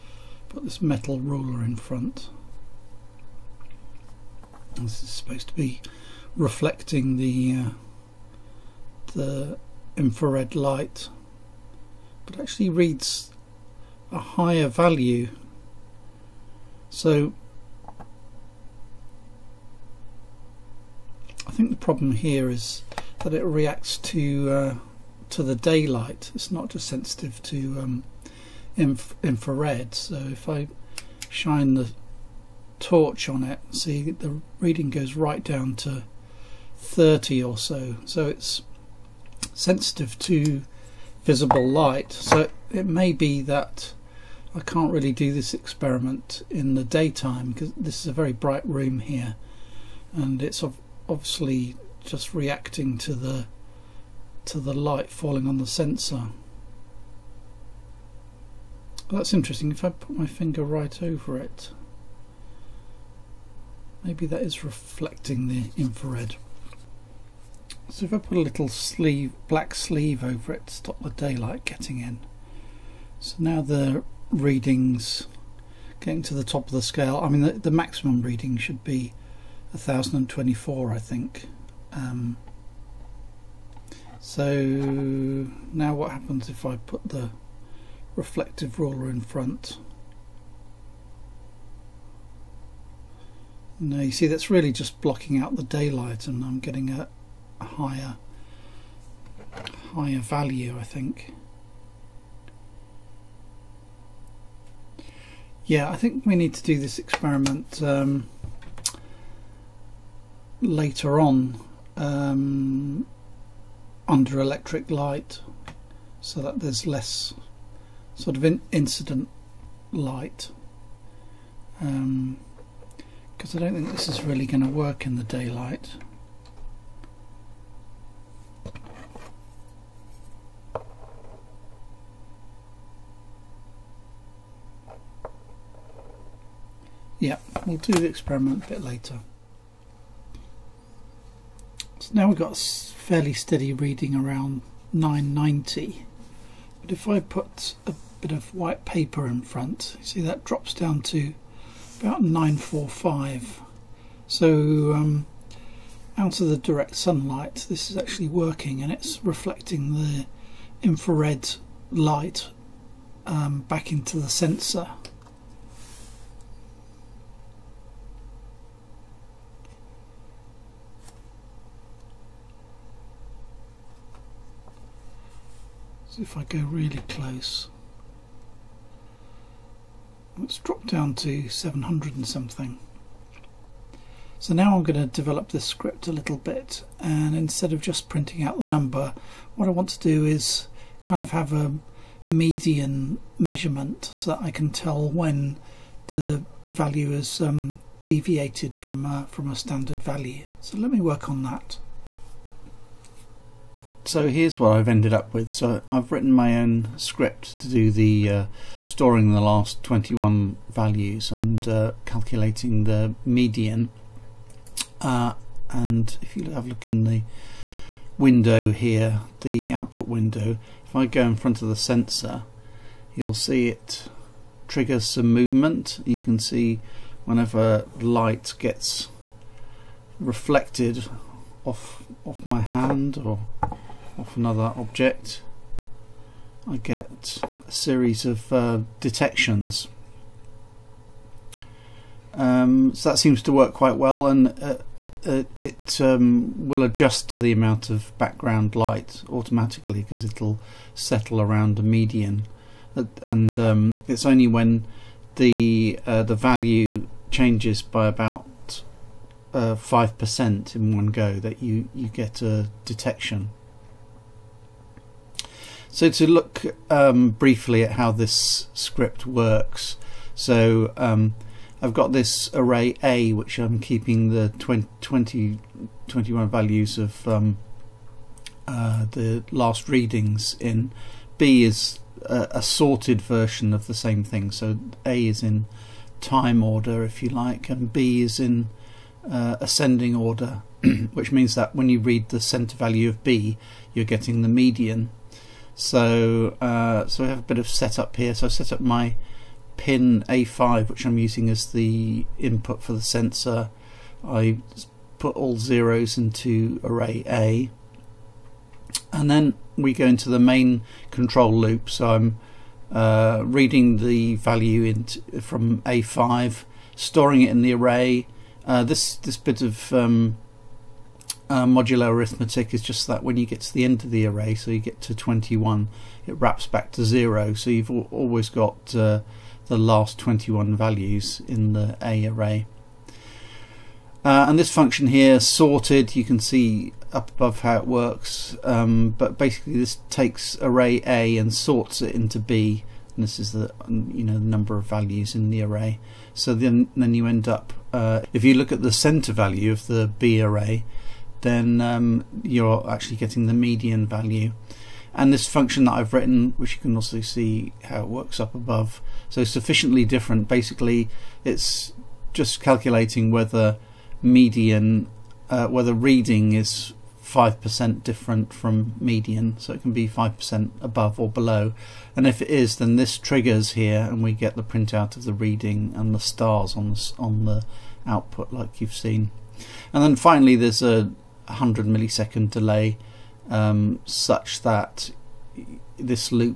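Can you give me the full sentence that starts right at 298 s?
So I set up my pin A5, which I'm using as the input for the sensor.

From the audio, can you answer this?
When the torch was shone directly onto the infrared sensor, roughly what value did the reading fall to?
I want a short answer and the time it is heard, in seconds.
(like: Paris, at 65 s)
30, at 36 s.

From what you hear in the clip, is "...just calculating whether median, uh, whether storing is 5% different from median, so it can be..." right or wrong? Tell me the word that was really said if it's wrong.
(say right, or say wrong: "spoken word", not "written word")
wrong: "reading", not "storing".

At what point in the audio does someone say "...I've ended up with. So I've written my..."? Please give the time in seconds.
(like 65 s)
204 s.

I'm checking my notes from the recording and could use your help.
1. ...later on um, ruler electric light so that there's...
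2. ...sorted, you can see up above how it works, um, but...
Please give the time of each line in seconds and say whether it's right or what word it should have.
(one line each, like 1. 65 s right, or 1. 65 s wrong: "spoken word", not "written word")
1. 110 s wrong: "under", not "ruler"
2. 335 s right.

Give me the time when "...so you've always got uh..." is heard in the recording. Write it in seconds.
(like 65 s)
327 s.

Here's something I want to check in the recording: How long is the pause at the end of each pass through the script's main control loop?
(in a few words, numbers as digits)
100 milliseconds.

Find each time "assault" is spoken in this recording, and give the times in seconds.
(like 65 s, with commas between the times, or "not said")
not said.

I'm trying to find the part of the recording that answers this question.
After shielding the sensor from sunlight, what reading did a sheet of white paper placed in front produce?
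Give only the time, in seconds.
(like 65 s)
151 s.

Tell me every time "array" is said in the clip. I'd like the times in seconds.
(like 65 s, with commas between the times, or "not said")
272 s, 306 s, 317 s, 324 s, 332 s, 340 s, 345 s, 350 s.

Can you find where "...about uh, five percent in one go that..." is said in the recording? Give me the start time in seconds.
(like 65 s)
258 s.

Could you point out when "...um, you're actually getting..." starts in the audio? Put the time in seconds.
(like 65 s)
351 s.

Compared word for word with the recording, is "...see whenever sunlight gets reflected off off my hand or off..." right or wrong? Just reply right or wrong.
wrong.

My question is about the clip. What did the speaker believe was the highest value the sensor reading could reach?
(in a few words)
1024.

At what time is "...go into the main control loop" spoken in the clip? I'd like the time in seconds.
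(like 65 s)
309 s.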